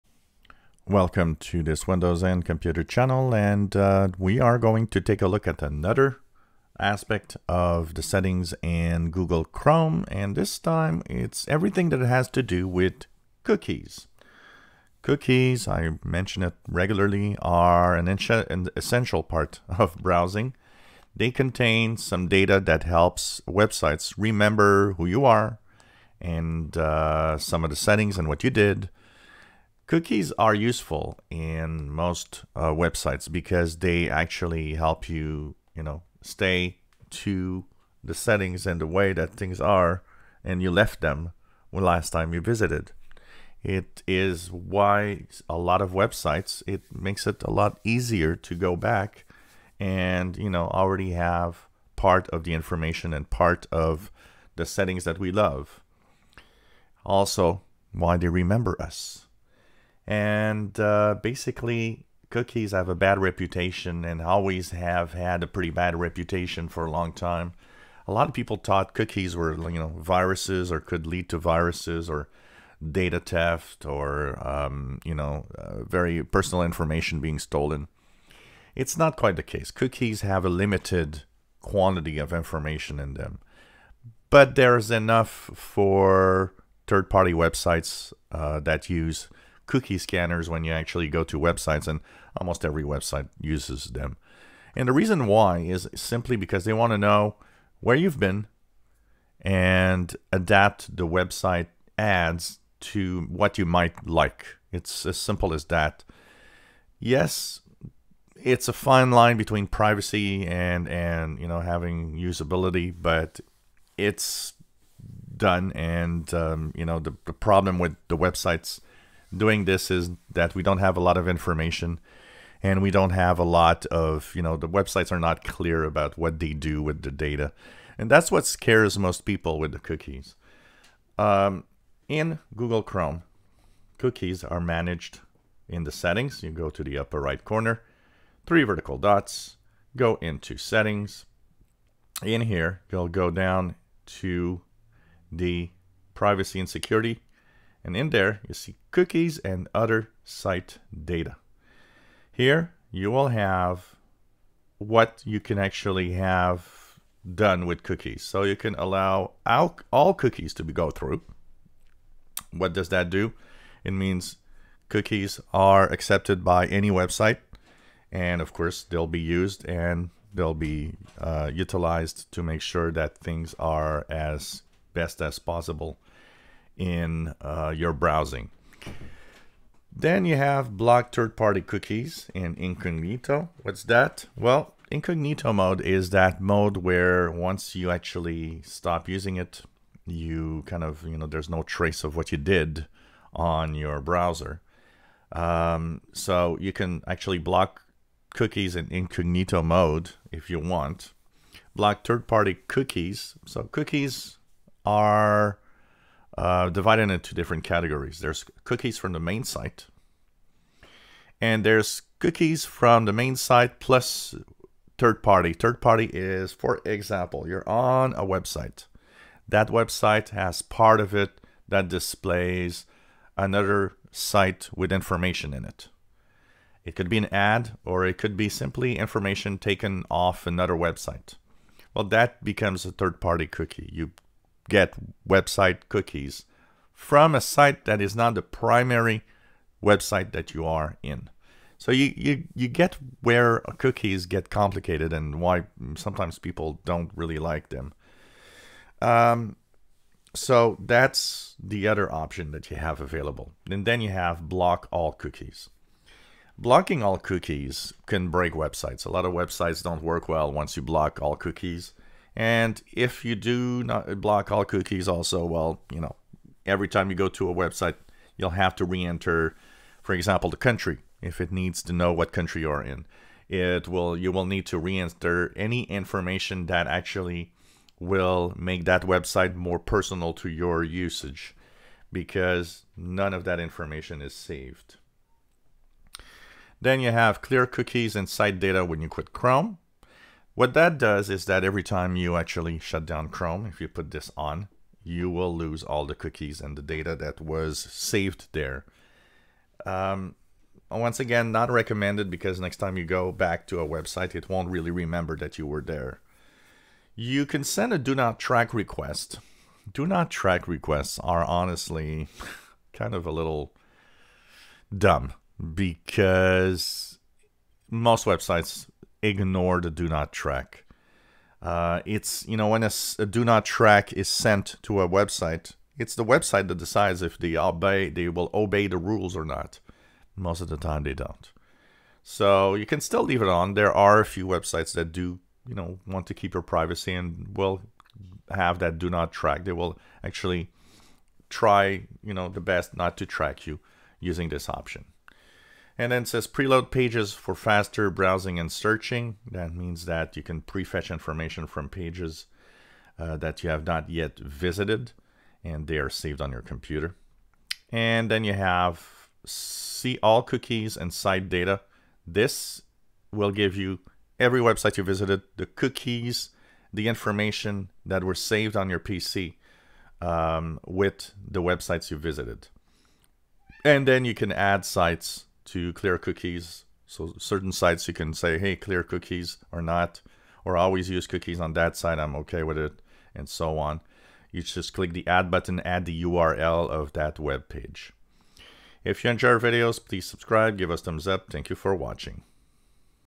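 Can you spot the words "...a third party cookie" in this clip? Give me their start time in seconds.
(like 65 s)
232 s.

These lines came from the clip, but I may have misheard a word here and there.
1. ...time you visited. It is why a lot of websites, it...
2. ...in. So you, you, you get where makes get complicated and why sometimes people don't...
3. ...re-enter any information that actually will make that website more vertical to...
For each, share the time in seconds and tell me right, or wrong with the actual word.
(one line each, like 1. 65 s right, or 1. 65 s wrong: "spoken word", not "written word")
1. 42 s right
2. 241 s wrong: "cookies", not "makes"
3. 274 s wrong: "personal", not "vertical".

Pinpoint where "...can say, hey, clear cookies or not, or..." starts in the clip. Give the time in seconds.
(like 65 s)
378 s.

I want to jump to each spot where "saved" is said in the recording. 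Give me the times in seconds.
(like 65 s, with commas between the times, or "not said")
284 s, 297 s, 356 s, 368 s.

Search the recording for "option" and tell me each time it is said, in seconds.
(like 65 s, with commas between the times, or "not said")
252 s, 344 s.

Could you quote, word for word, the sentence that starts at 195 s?
Um, so you can actually block cookies in incognito mode if you want.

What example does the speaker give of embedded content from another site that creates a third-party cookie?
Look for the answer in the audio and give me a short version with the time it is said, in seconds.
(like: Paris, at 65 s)
An ad, at 227 s.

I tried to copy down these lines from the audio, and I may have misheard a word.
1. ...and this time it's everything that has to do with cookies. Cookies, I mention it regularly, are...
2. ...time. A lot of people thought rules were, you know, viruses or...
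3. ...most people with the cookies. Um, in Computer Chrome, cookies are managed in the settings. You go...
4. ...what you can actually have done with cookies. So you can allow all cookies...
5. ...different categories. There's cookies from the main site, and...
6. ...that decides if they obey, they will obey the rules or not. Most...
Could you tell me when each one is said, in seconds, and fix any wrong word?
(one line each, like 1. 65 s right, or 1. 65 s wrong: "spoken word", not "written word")
1. 10 s right
2. 67 s wrong: "cookies", not "rules"
3. 128 s wrong: "Google", not "Computer"
4. 154 s right
5. 207 s right
6. 326 s right.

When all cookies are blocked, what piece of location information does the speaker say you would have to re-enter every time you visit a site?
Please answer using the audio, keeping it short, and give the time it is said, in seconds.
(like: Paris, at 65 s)
The country, at 270 s.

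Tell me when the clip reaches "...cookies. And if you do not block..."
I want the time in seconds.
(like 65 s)
261 s.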